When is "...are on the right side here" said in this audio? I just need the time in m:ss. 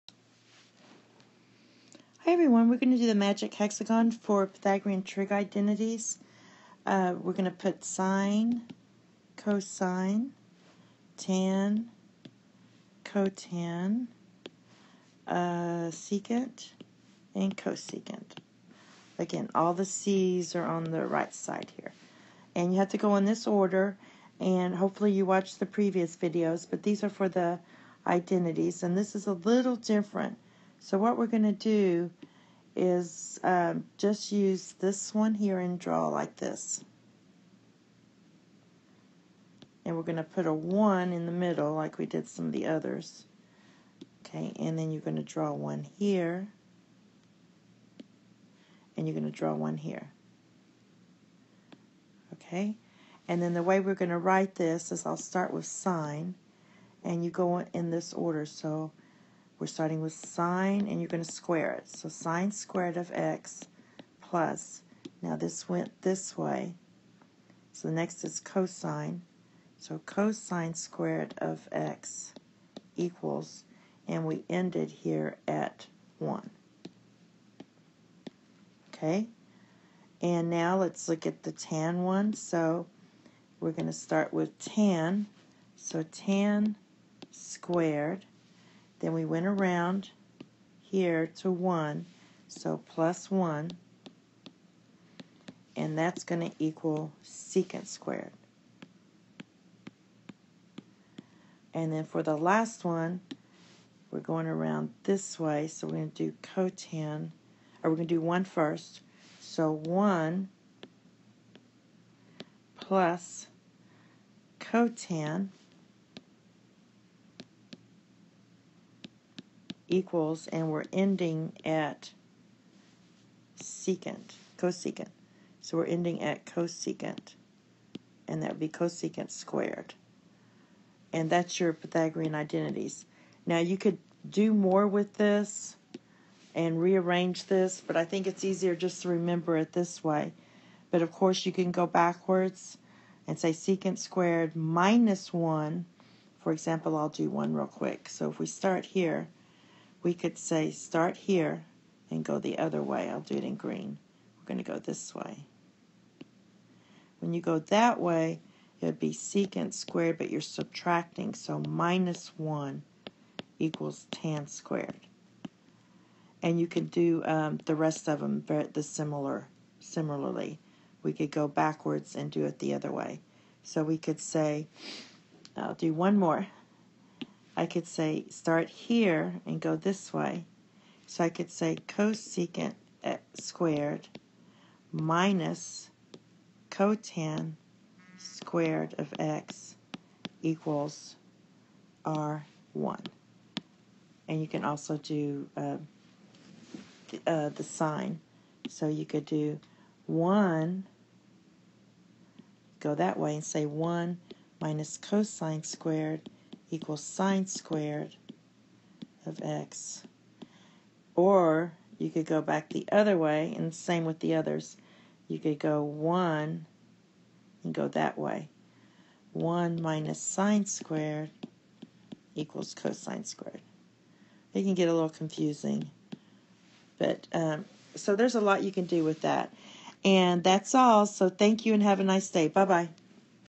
0:20.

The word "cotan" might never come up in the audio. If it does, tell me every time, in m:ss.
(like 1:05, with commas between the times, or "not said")
0:13, 1:46, 1:54, 3:06.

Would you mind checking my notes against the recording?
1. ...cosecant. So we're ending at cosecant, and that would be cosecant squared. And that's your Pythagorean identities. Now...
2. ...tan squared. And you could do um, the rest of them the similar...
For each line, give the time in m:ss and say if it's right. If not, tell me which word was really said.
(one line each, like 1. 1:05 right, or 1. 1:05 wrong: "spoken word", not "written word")
1. 2:04 right
2. 2:44 right.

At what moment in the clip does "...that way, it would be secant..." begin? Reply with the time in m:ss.
2:37.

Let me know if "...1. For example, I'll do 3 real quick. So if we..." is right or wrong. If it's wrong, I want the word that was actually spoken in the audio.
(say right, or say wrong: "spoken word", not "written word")
wrong: "1", not "3".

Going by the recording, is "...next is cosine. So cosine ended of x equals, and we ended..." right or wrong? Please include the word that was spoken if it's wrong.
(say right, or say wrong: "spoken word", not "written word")
wrong: "squared", not "ended".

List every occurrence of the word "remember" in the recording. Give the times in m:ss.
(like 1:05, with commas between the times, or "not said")
2:19.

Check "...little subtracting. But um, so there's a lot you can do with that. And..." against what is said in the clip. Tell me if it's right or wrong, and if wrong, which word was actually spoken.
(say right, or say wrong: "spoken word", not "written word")
wrong: "confusing", not "subtracting".